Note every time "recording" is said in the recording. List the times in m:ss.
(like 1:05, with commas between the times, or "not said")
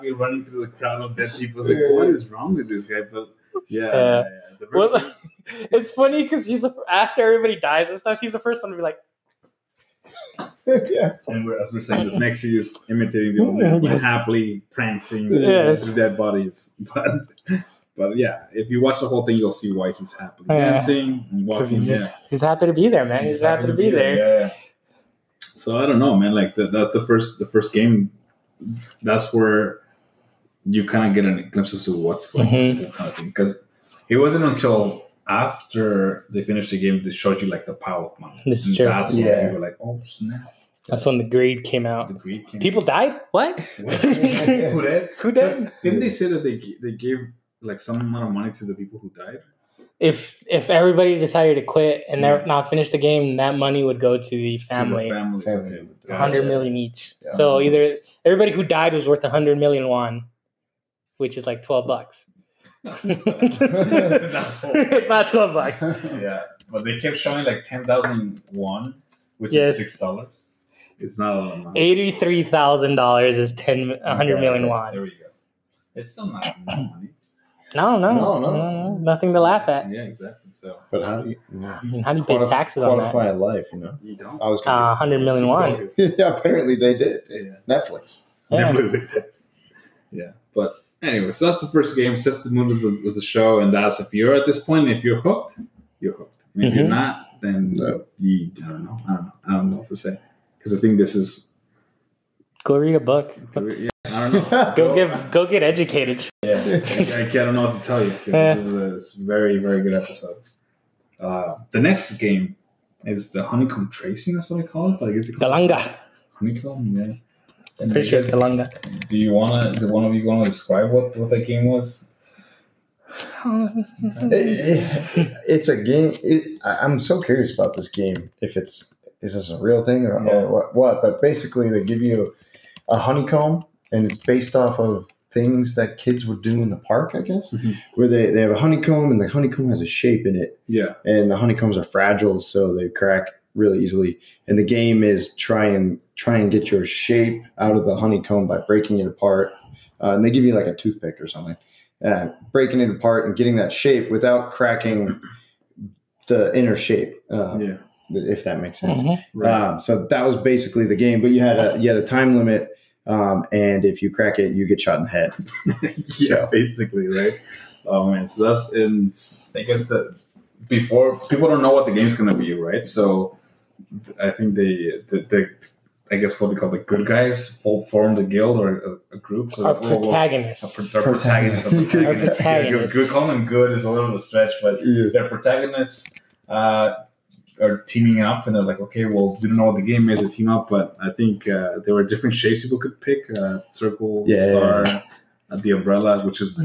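not said.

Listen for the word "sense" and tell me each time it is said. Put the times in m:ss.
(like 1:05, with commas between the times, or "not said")
2:38.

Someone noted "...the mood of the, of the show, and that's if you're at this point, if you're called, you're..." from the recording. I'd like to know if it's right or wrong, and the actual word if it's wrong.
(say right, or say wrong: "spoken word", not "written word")
wrong: "hooked", not "called".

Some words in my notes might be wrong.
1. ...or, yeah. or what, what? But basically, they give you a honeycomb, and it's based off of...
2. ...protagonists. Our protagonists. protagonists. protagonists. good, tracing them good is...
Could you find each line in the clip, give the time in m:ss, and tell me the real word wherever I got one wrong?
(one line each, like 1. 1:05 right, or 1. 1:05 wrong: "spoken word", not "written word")
1. 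2:10 right
2. 2:59 wrong: "calling", not "tracing".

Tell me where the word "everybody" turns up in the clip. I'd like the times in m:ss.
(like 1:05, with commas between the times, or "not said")
0:07, 0:50, 0:58.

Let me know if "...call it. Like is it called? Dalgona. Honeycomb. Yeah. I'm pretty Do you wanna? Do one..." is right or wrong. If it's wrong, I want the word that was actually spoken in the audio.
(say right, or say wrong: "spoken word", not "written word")
right.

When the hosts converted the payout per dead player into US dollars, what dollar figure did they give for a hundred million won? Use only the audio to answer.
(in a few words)
$83,000.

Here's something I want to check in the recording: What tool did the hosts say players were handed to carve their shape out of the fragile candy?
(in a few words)
a toothpick.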